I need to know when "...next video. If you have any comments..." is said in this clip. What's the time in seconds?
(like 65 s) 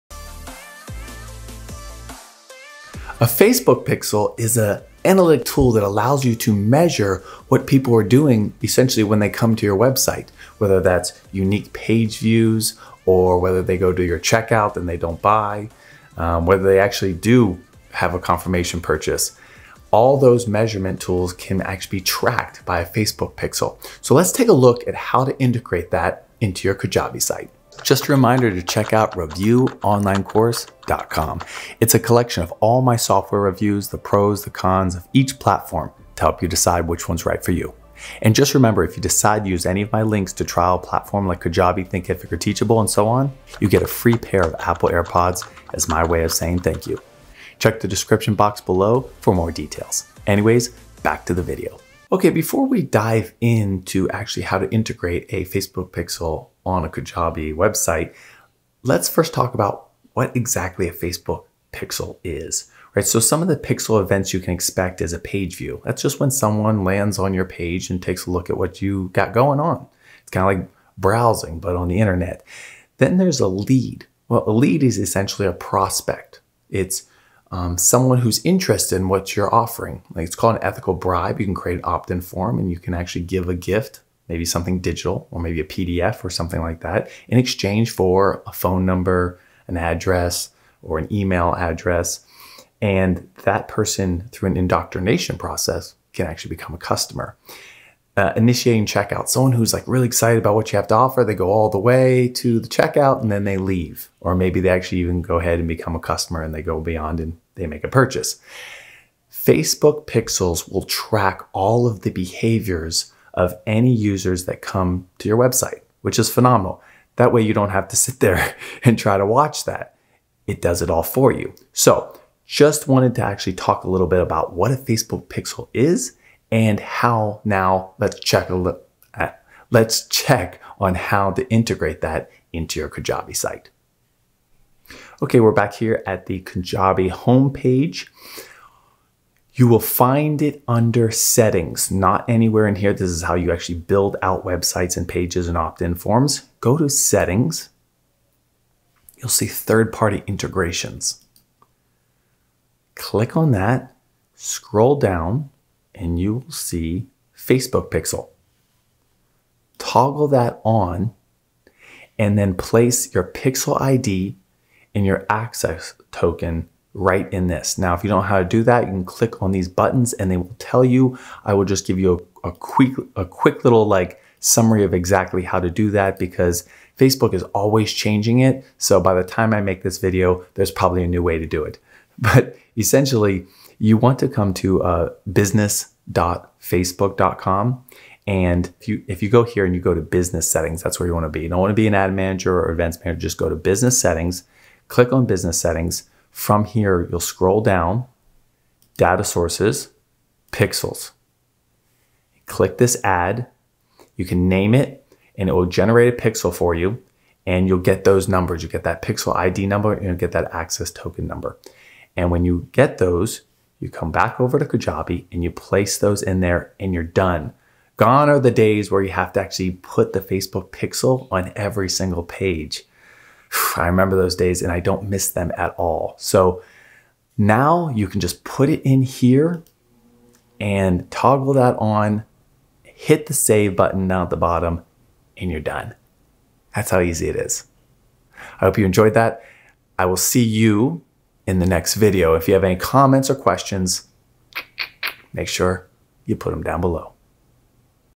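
241 s.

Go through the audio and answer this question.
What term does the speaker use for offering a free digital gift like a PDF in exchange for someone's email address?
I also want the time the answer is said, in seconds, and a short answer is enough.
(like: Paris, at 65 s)
ethical bribe, at 80 s.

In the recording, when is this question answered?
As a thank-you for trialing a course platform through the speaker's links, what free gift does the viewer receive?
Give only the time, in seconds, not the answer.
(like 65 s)
44 s.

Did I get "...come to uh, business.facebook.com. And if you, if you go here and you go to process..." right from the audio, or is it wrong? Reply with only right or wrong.
wrong.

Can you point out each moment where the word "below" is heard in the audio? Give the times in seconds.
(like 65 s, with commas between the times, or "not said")
48 s, 246 s.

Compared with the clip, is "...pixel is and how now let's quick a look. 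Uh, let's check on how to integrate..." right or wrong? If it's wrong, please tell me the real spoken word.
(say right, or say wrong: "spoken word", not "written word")
wrong: "check", not "quick".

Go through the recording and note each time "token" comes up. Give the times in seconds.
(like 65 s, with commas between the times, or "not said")
166 s, 210 s.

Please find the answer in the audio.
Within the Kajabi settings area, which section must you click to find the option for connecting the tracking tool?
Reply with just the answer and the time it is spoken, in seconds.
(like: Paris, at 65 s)
third party integrations, at 149 s.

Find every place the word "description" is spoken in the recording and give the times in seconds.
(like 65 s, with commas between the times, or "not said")
47 s.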